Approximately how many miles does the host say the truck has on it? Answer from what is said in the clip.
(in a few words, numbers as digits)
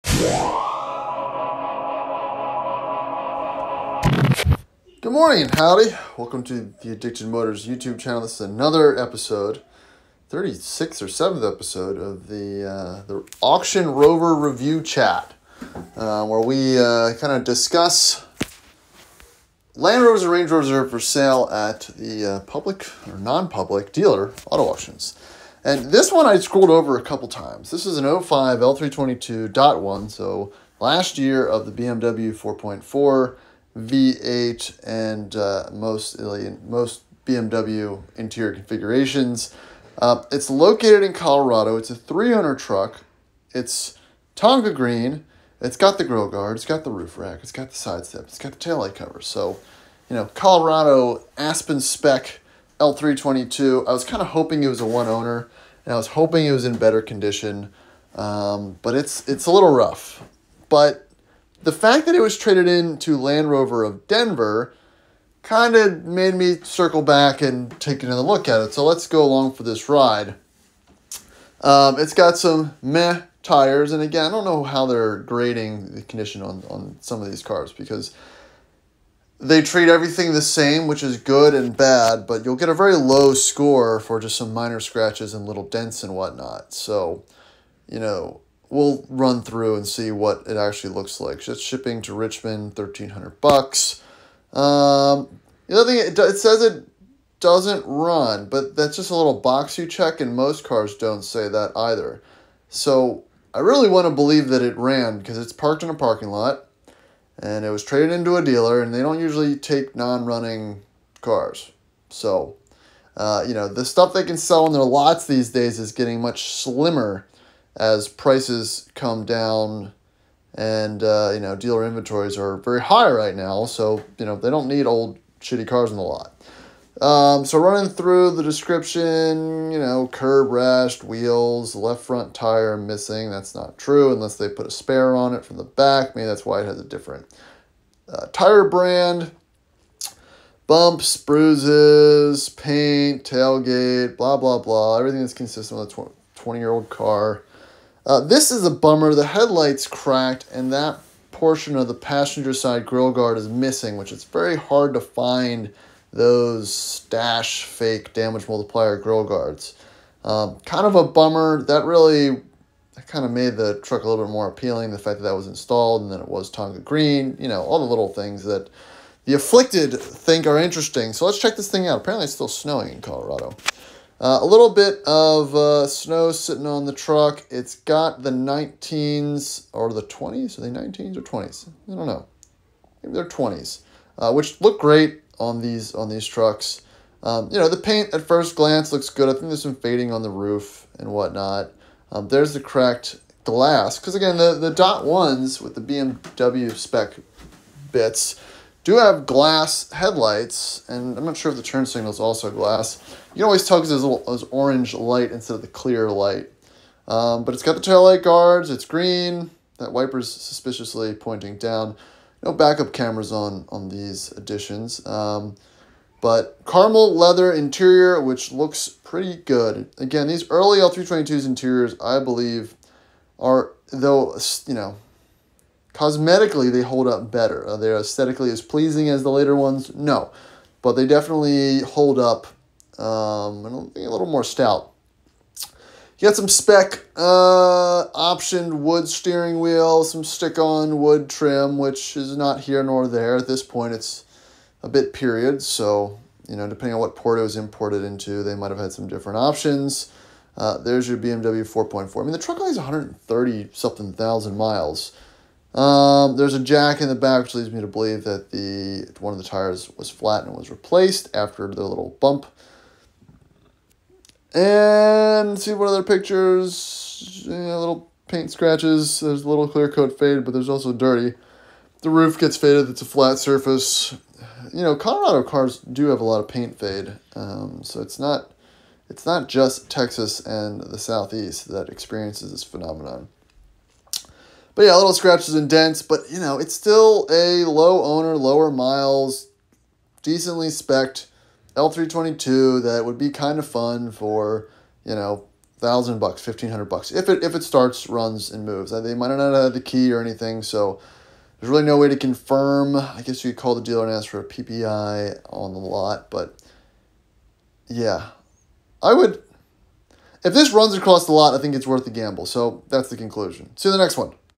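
130 something thousand.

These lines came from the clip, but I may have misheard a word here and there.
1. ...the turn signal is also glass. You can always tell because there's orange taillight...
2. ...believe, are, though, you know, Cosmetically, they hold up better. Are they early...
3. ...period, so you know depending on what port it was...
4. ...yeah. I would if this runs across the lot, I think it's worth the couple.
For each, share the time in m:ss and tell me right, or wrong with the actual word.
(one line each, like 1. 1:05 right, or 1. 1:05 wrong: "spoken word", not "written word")
1. 3:21 wrong: "light", not "taillight"
2. 3:42 wrong: "aesthetically", not "early"
3. 4:05 right
4. 5:07 wrong: "gamble", not "couple".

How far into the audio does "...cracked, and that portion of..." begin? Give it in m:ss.
2:29.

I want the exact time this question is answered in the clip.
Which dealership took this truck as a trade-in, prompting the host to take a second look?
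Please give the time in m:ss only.
1:03.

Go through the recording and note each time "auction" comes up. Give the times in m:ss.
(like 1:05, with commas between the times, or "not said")
0:13, 0:24.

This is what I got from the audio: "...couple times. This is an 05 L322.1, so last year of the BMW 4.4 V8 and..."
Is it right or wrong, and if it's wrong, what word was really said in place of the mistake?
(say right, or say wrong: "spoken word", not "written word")
right.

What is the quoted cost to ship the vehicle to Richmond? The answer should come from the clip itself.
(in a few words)
$1,300.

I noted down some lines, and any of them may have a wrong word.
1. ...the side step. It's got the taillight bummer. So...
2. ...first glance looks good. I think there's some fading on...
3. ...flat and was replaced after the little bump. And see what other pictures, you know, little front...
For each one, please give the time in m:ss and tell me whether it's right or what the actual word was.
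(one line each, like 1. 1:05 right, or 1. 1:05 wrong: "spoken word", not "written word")
1. 0:47 wrong: "cover", not "bummer"
2. 3:08 right
3. 4:20 wrong: "paint", not "front".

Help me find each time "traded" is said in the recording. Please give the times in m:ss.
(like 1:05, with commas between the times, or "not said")
1:02, 1:47.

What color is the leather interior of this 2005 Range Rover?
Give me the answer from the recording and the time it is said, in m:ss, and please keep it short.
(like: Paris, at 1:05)
Caramel, at 3:36.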